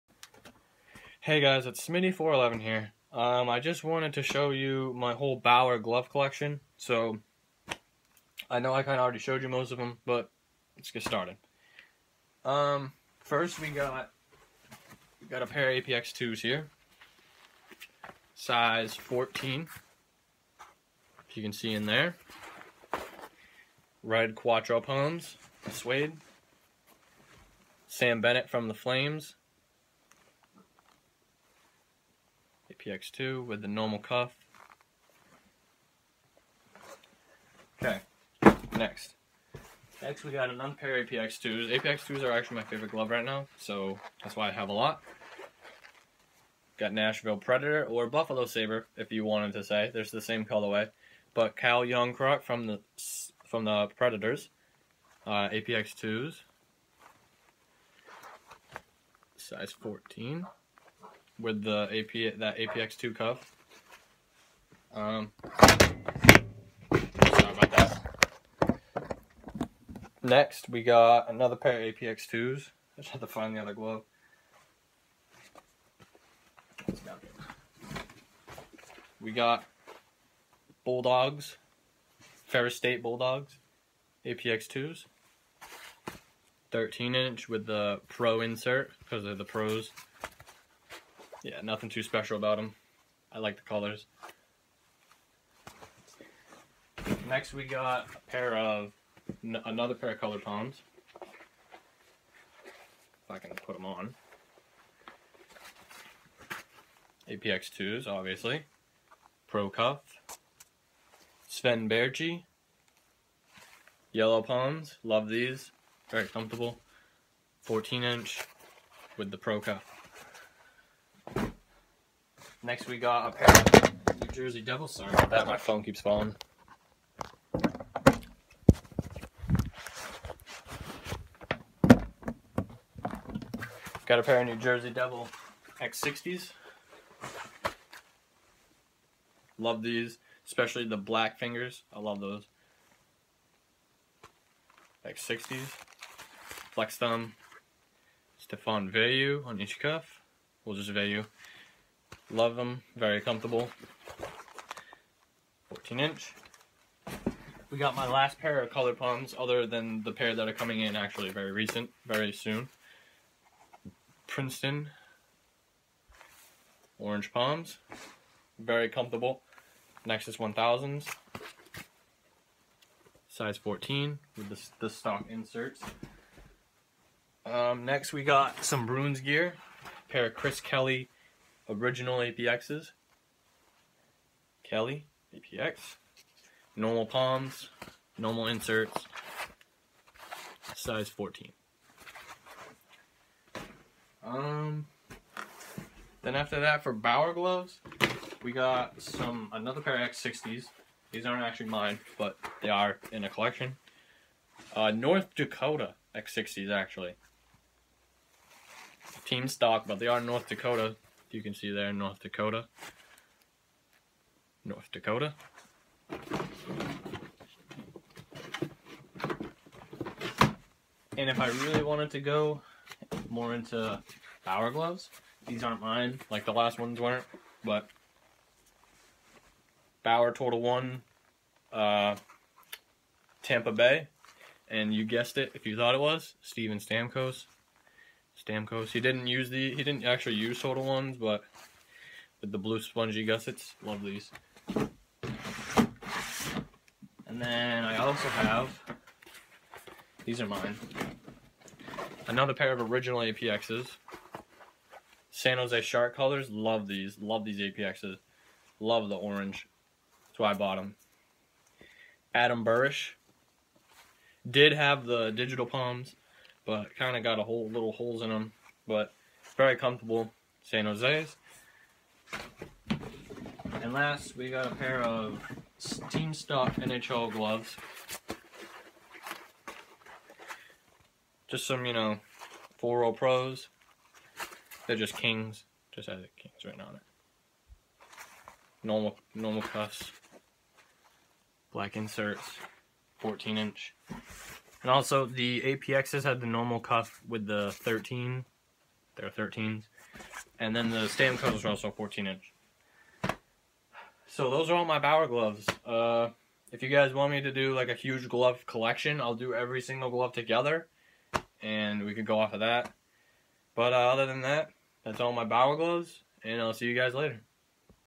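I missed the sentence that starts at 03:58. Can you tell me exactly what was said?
He didn't use the he didn't actually use total ones, but with the blue spongy gussets, love these.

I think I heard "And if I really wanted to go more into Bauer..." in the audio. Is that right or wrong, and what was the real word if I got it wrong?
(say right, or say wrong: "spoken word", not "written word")
right.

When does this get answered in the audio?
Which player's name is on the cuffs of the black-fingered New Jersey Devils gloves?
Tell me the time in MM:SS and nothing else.
02:28.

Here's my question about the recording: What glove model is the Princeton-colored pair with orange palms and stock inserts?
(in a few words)
Nexus 1000.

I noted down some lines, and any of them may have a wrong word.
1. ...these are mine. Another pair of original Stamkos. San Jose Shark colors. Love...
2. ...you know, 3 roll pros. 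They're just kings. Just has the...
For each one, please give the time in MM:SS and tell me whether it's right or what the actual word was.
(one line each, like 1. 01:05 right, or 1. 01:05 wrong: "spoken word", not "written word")
1. 04:10 wrong: "APXs", not "Stamkos"
2. 04:41 wrong: "4", not "3".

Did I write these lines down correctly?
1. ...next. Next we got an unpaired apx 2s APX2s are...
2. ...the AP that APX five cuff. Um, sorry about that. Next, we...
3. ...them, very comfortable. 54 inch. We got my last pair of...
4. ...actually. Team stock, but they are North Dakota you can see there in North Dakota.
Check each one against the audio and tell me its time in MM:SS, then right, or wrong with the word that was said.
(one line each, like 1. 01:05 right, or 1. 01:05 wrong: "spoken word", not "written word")
1. 00:38 right
2. 01:01 wrong: "two", not "five"
3. 02:32 wrong: "14", not "54"
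4. 03:26 right.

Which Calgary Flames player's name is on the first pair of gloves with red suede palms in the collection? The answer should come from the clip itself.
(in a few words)
Sam Bennett.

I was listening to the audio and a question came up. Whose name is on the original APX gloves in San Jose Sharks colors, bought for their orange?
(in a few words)
Adam Burish.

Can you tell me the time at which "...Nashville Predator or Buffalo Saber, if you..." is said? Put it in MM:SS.
00:46.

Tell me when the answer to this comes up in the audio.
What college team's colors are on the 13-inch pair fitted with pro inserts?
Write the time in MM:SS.
01:22.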